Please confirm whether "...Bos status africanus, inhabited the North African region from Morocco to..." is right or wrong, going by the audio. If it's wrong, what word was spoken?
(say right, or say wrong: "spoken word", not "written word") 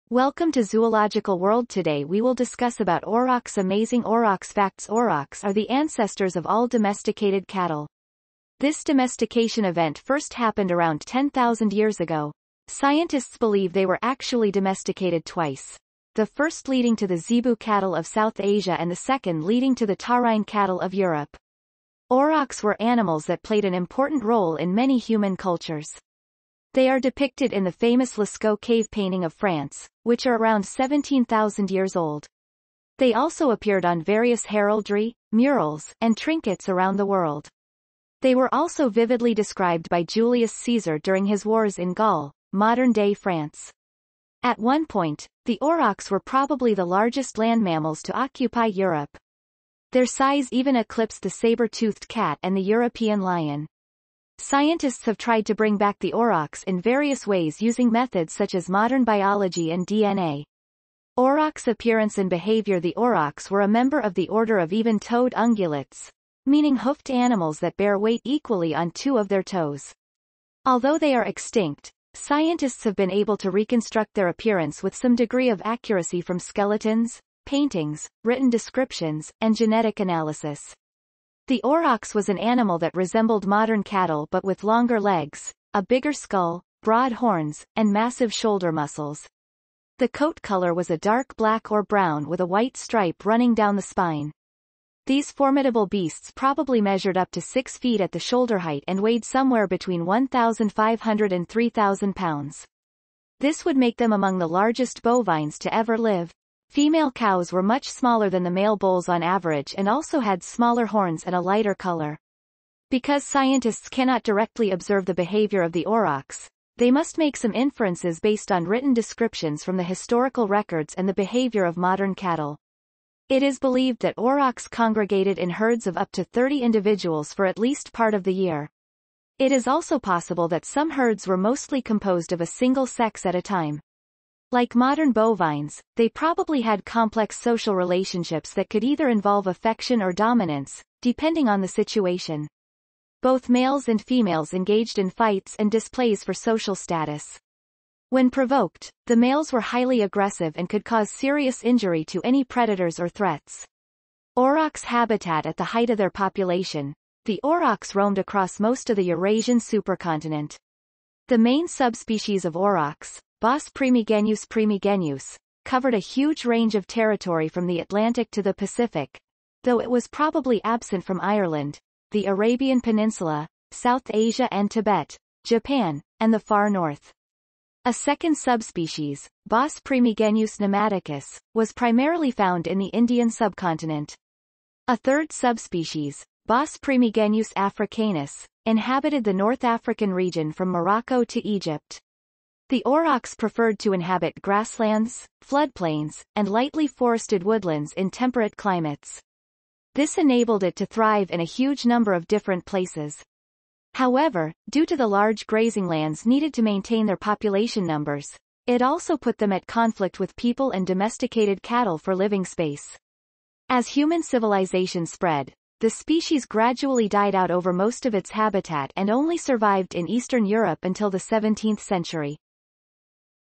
wrong: "primigenius", not "status".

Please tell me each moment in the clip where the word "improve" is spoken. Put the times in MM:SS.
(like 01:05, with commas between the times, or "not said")
not said.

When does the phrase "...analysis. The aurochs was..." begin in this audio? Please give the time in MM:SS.
01:19.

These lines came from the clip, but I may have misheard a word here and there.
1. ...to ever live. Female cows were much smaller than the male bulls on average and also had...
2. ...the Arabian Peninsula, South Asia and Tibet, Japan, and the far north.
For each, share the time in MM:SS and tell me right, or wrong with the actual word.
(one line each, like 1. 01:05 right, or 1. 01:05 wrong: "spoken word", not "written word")
1. 01:45 right
2. 02:52 right.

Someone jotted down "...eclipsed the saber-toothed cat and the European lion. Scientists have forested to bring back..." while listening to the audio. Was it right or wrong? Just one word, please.
wrong.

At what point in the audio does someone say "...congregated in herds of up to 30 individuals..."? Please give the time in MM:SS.
02:04.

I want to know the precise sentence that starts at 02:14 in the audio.
Like modern bovines, they probably had complex social relationships that could either involve affection or dominance, depending on the situation.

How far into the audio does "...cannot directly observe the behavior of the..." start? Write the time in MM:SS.
01:53.